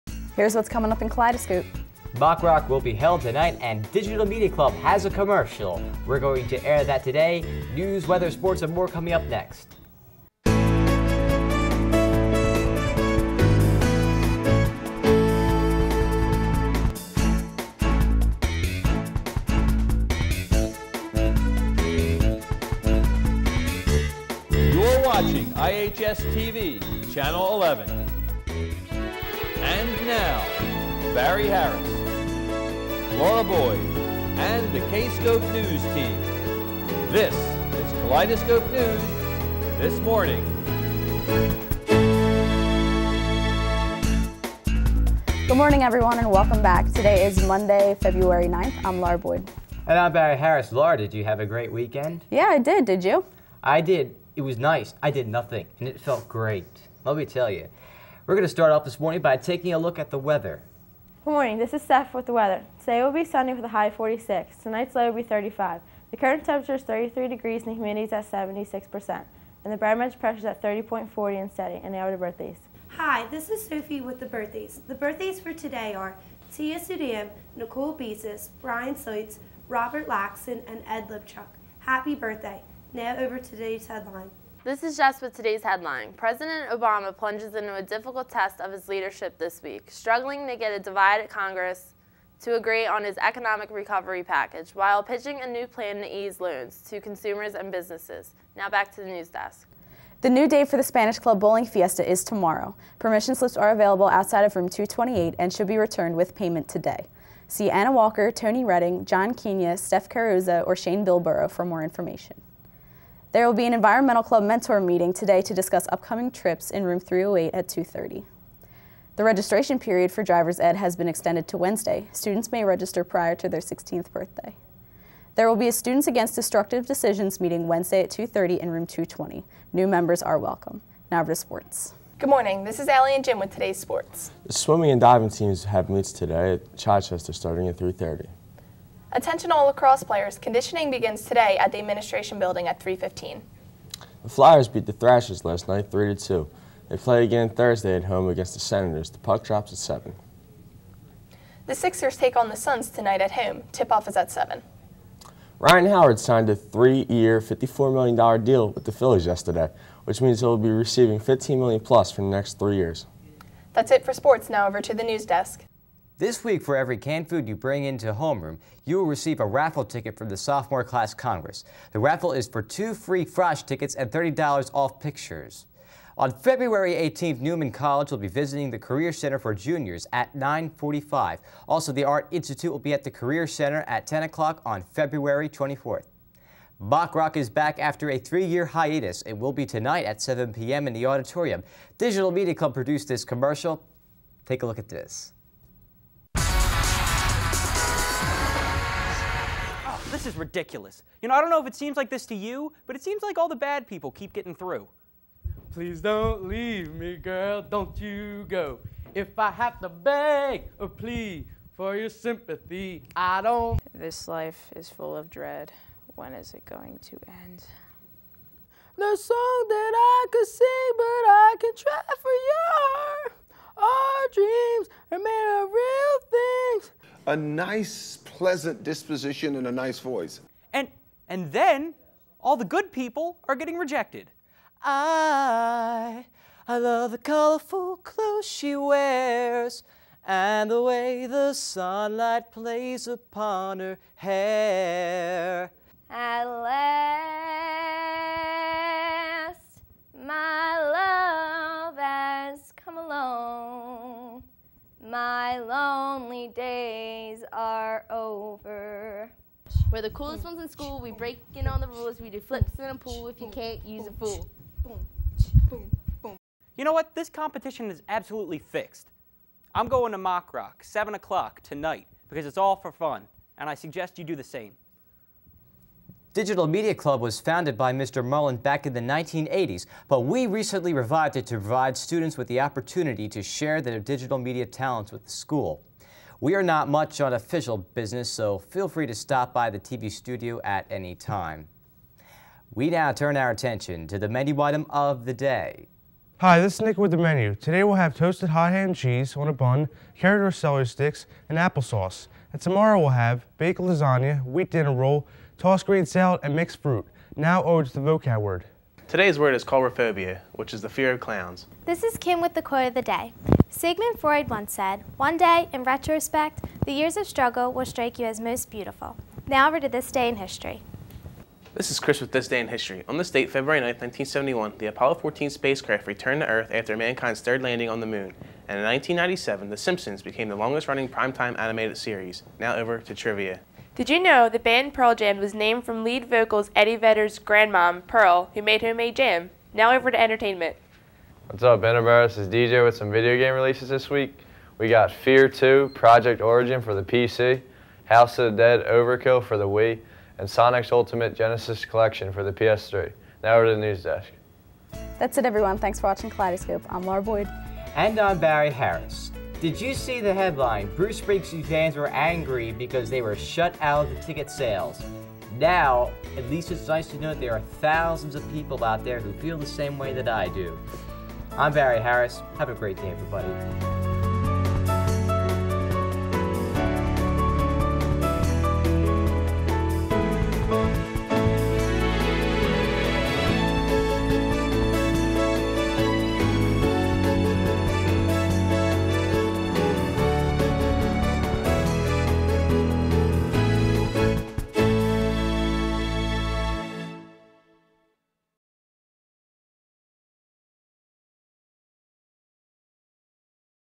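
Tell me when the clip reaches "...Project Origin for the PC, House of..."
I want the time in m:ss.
5:45.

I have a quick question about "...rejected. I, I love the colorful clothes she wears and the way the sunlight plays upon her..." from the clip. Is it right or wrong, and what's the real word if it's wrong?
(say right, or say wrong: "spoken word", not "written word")
right.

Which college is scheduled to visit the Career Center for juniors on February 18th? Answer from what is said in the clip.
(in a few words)
Neumann College.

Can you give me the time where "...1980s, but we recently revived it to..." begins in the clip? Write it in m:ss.
4:39.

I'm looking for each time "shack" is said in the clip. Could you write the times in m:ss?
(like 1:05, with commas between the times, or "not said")
not said.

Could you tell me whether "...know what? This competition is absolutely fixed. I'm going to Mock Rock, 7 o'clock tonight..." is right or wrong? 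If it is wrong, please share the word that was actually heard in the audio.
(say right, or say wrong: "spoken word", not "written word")
right.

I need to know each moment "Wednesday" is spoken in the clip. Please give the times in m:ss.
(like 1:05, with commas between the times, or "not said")
2:01, 2:07.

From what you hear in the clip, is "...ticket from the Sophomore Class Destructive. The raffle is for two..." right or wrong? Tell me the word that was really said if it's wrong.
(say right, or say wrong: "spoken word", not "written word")
wrong: "Congress", not "Destructive".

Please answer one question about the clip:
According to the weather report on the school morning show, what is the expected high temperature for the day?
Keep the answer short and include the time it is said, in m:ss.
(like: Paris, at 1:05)
46, at 1:03.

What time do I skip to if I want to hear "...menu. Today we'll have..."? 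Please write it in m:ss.
4:57.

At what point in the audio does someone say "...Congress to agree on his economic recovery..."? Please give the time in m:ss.
1:31.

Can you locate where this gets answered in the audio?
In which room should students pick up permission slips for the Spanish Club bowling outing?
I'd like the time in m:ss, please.
1:44.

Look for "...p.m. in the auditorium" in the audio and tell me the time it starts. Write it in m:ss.
3:10.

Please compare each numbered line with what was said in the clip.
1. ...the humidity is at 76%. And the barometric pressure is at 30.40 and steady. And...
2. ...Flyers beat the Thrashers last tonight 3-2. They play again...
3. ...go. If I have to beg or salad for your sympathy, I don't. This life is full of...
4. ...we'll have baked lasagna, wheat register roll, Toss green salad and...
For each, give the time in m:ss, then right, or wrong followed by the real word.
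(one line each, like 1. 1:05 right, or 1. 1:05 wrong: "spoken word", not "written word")
1. 1:07 right
2. 2:24 wrong: "night", not "tonight"
3. 3:28 wrong: "plead", not "salad"
4. 5:02 wrong: "dinner", not "register".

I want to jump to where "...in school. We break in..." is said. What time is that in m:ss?
4:20.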